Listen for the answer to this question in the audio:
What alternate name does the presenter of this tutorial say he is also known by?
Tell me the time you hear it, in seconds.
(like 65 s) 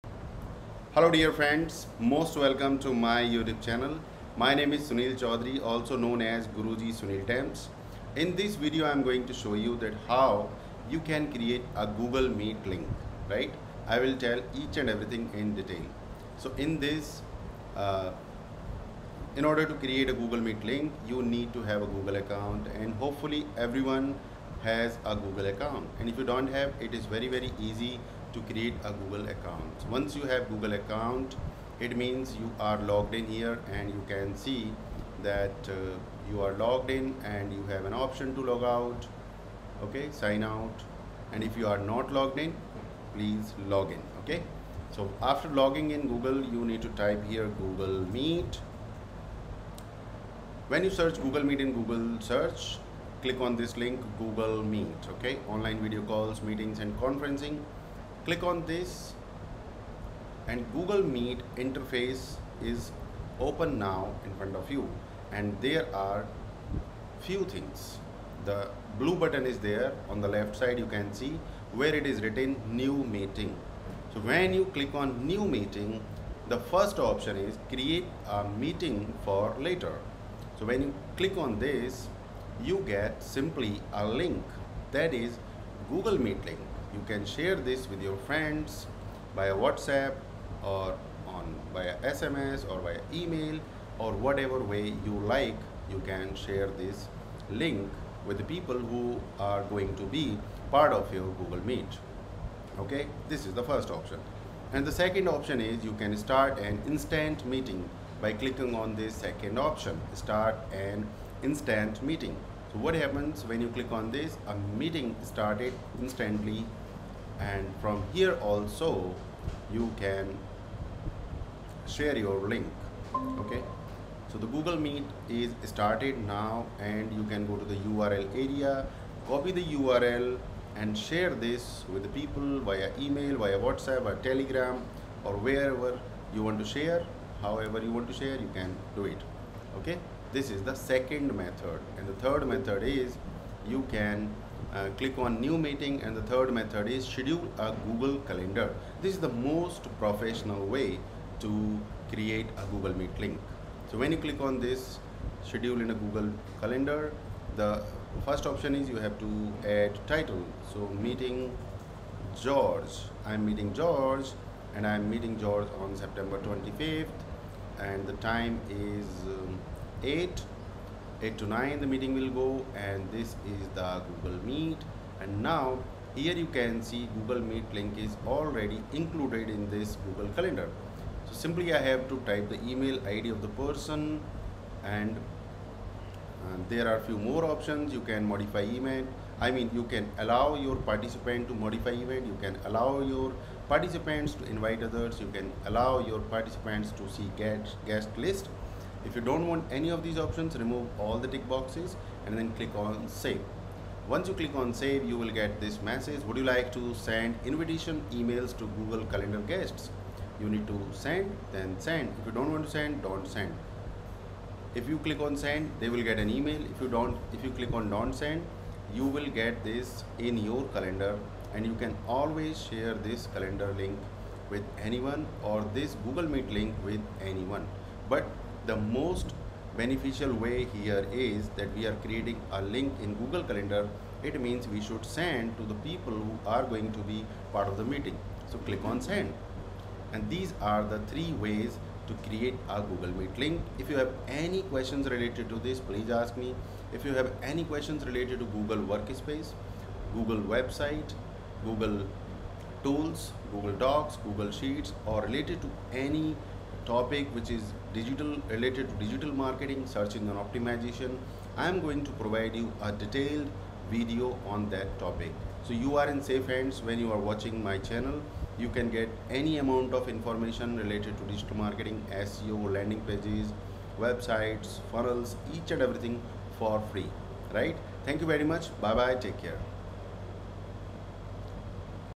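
6 s.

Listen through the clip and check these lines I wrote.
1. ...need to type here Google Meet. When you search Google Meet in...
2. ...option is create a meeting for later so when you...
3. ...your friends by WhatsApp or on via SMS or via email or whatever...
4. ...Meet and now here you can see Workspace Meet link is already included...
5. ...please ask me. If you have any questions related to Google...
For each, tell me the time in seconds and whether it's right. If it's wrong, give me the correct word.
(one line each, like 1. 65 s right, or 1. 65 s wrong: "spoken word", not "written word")
1. 46 s right
2. 76 s right
3. 88 s right
4. 174 s wrong: "Google", not "Workspace"
5. 245 s right.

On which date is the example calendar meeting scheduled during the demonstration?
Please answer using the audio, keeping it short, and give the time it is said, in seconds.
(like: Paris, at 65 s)
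September 25th, at 165 s.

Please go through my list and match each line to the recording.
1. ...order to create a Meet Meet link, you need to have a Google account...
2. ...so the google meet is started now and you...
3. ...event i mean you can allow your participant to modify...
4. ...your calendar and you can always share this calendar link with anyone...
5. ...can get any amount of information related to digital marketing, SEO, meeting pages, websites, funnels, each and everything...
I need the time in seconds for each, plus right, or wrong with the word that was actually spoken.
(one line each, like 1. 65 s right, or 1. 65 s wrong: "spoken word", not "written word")
1. 19 s wrong: "Google", not "Meet"
2. 124 s right
3. 188 s right
4. 220 s right
5. 268 s wrong: "landing", not "meeting".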